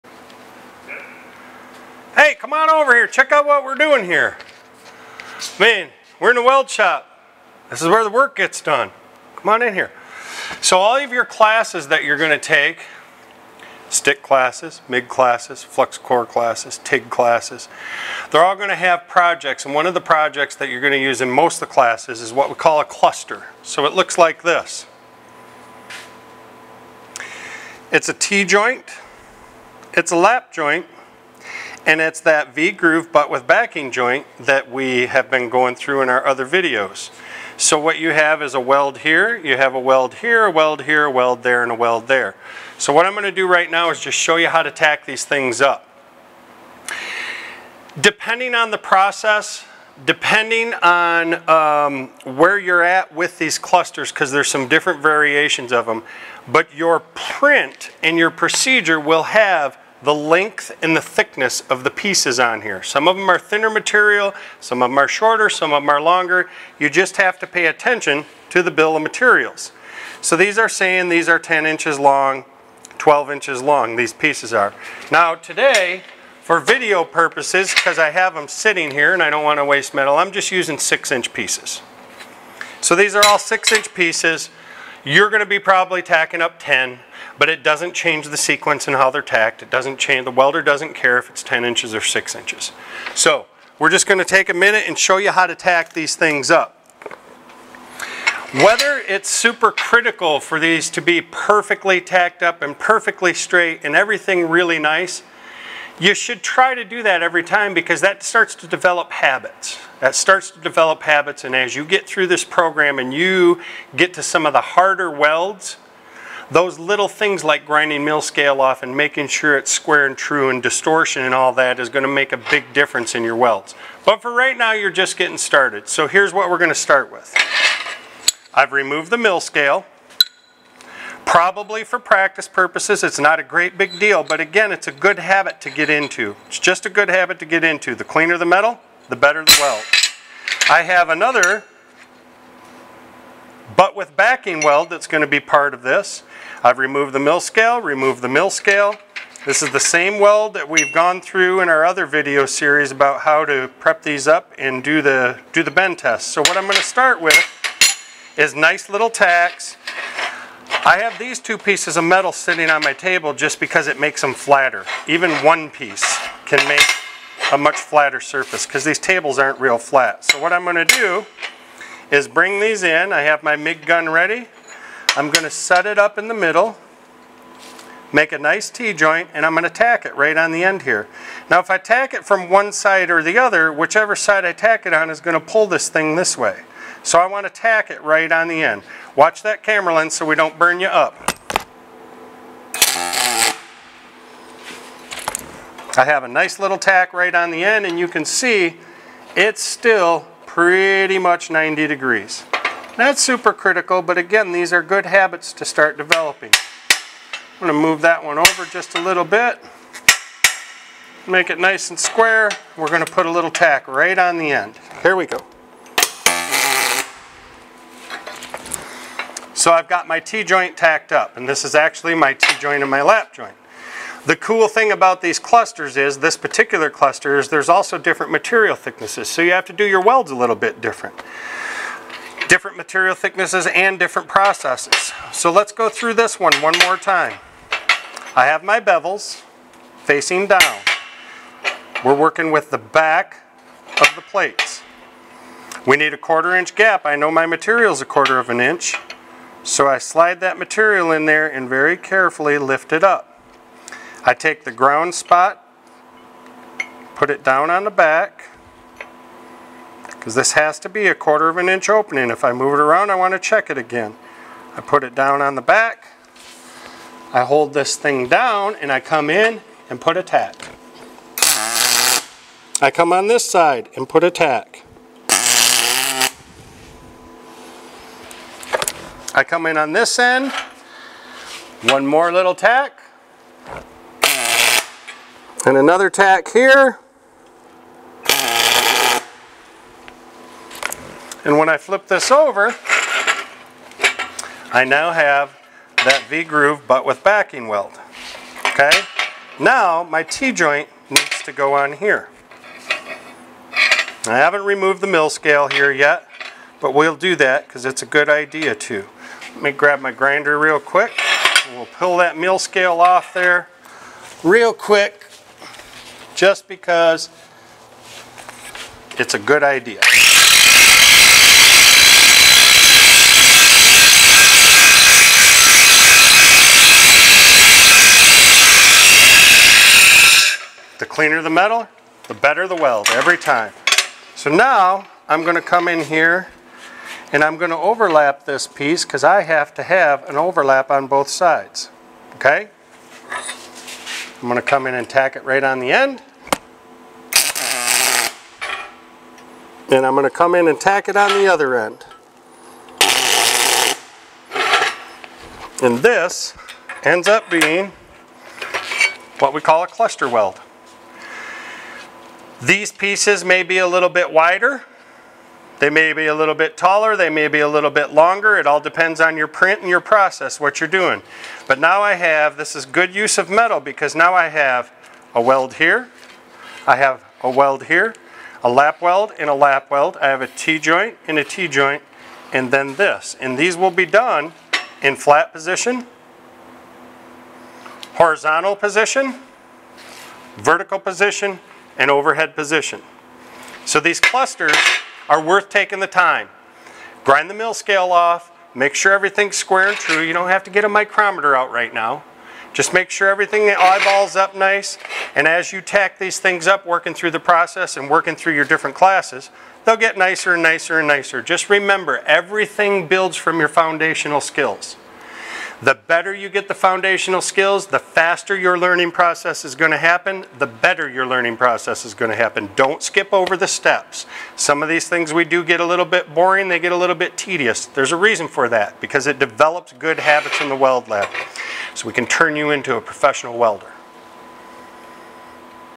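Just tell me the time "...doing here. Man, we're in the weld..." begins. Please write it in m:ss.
0:03.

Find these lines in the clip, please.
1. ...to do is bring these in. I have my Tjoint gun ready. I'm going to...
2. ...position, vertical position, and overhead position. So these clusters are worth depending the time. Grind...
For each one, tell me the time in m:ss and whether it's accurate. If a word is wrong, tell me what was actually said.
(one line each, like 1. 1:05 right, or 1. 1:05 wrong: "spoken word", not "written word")
1. 2:50 wrong: "MIG", not "Tjoint"
2. 6:28 wrong: "taking", not "depending".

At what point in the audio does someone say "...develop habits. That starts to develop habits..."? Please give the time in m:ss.
1:48.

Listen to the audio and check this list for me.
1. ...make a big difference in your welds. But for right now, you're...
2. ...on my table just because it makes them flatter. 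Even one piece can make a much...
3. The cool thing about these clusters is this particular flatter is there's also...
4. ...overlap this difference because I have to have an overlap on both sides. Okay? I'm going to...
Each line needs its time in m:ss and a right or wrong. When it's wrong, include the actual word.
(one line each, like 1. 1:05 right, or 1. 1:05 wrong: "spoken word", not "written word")
1. 2:02 right
2. 2:42 right
3. 3:44 wrong: "cluster", not "flatter"
4. 5:37 wrong: "piece", not "difference".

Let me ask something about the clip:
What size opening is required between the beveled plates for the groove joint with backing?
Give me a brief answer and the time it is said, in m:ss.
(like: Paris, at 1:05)
quarter inch, at 4:05.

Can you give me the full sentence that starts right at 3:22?
Not super critical, but again, these are good habits to start developing.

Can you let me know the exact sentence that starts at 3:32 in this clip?
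We're gonna put a little tack right on the end.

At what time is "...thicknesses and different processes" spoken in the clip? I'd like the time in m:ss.
3:53.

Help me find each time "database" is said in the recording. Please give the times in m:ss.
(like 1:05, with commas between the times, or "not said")
not said.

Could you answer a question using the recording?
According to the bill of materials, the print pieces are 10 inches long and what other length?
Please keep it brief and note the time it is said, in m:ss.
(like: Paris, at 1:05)
12 inches, at 1:12.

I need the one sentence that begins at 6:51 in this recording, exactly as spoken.
Just remember, everything builds from your foundational skills.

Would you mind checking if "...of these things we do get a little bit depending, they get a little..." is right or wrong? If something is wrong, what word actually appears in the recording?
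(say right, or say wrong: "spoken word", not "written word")
wrong: "boring", not "depending".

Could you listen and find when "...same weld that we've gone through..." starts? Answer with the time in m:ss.
2:29.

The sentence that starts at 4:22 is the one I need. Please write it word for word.
If I move it around, I want to check it again.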